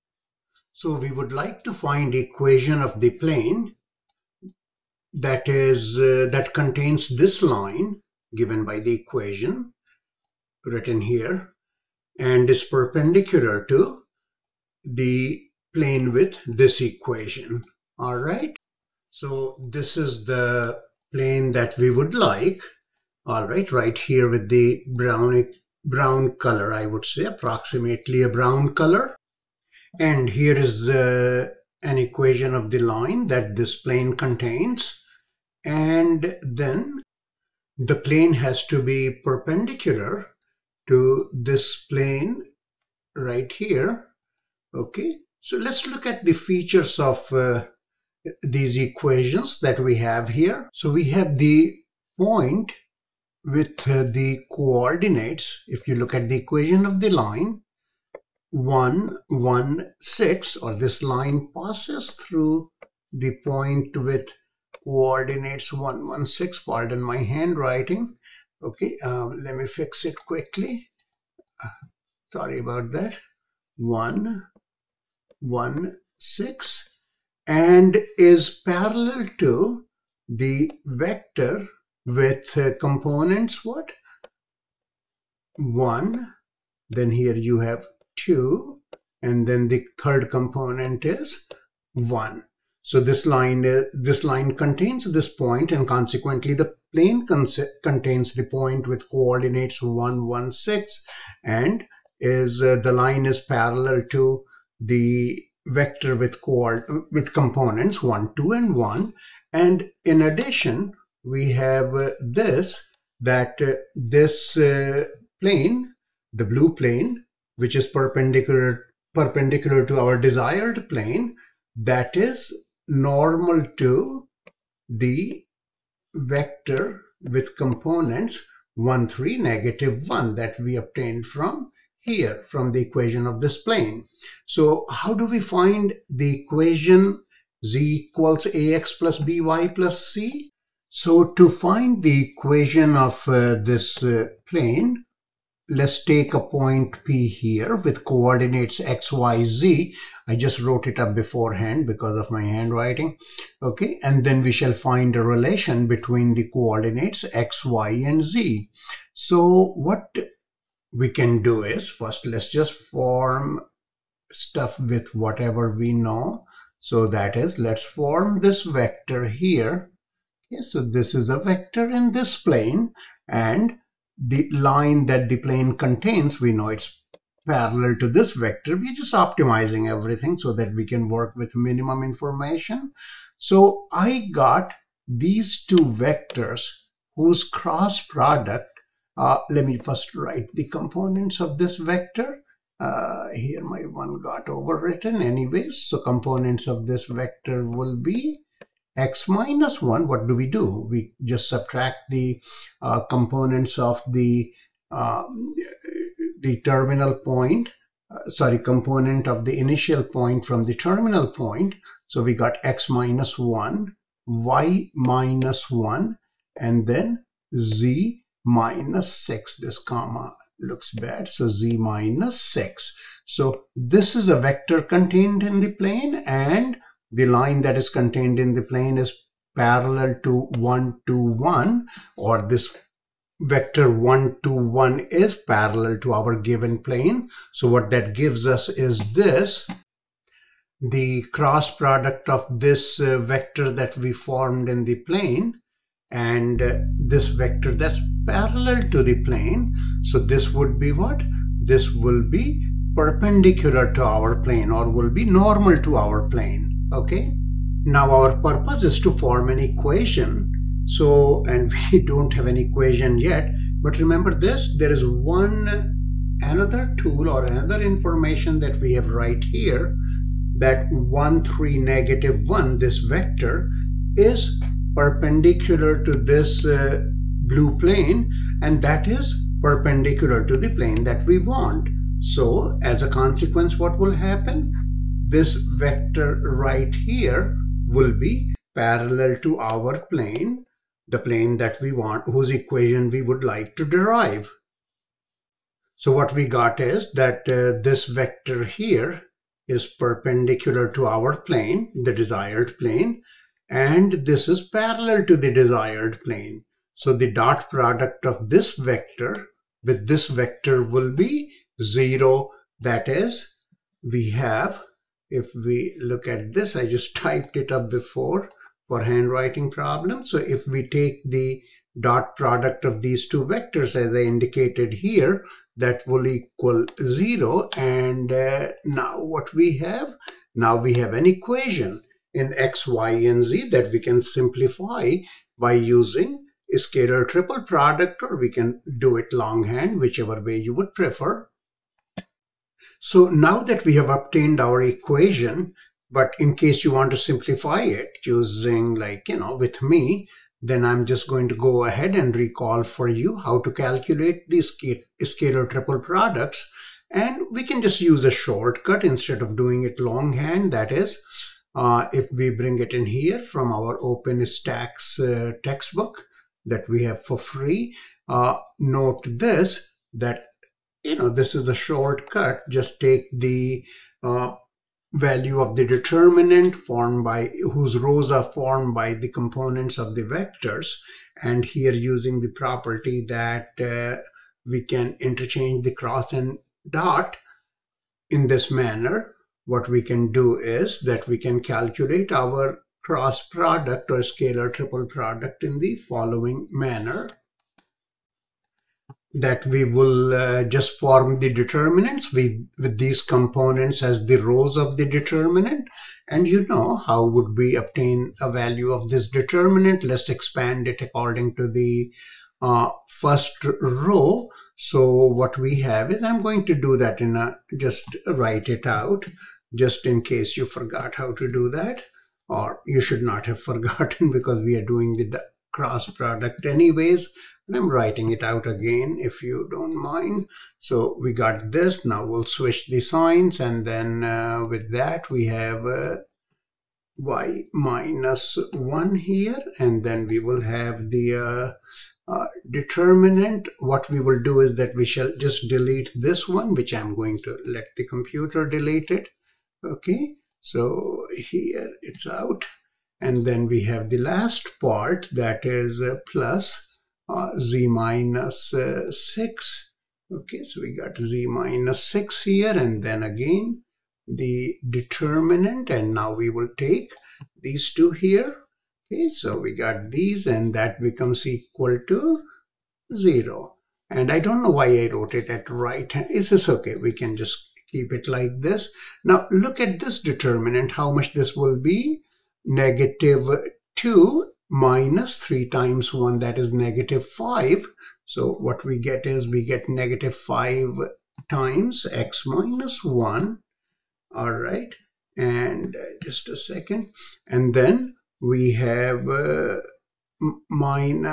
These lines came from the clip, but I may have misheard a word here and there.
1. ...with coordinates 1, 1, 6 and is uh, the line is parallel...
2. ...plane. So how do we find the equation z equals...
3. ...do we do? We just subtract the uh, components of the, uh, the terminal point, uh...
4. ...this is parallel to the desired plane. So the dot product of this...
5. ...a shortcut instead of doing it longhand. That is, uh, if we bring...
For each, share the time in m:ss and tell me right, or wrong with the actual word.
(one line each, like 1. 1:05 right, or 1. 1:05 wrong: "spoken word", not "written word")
1. 1:38 right
2. 2:13 right
3. 3:20 right
4. 5:04 right
5. 5:58 right.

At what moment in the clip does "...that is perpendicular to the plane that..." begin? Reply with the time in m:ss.
4:38.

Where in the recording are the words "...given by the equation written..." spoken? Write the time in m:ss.
0:08.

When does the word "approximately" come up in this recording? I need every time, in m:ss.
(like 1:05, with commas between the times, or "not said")
0:27.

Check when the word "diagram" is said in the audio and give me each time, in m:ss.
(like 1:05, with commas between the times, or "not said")
not said.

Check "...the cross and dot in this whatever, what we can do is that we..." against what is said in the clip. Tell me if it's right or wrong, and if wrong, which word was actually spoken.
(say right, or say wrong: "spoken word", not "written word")
wrong: "manner", not "whatever".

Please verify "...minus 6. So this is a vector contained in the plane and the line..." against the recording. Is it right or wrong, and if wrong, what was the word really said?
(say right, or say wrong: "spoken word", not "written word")
right.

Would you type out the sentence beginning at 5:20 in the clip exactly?
So if we take the dot product of these two vectors as I indicated here, that will equal zero.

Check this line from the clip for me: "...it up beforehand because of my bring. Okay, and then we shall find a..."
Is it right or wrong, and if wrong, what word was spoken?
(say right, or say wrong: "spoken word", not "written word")
wrong: "handwriting", not "bring".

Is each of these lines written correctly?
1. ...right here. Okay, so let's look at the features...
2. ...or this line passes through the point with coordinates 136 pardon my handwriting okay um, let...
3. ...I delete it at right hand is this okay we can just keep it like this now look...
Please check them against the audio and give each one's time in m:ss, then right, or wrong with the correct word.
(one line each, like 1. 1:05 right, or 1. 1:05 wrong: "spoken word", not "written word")
1. 0:43 right
2. 1:00 wrong: "116", not "136"
3. 7:54 wrong: "wrote", not "delete".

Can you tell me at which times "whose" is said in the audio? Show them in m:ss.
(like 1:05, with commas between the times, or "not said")
3:07, 4:52, 6:17.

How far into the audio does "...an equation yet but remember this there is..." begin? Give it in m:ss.
4:22.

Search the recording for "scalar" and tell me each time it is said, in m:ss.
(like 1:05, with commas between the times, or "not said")
5:36, 5:55, 6:34.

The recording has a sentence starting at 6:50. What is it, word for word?
Let's expand it according to the uh, first row.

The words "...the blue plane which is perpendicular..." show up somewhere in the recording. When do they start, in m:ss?
1:56.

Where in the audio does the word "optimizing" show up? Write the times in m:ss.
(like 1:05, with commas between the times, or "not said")
2:59.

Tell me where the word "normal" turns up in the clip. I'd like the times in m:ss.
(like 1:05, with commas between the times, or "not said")
2:02, 4:15.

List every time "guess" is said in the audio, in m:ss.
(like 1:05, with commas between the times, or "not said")
not said.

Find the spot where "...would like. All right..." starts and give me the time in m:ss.
0:21.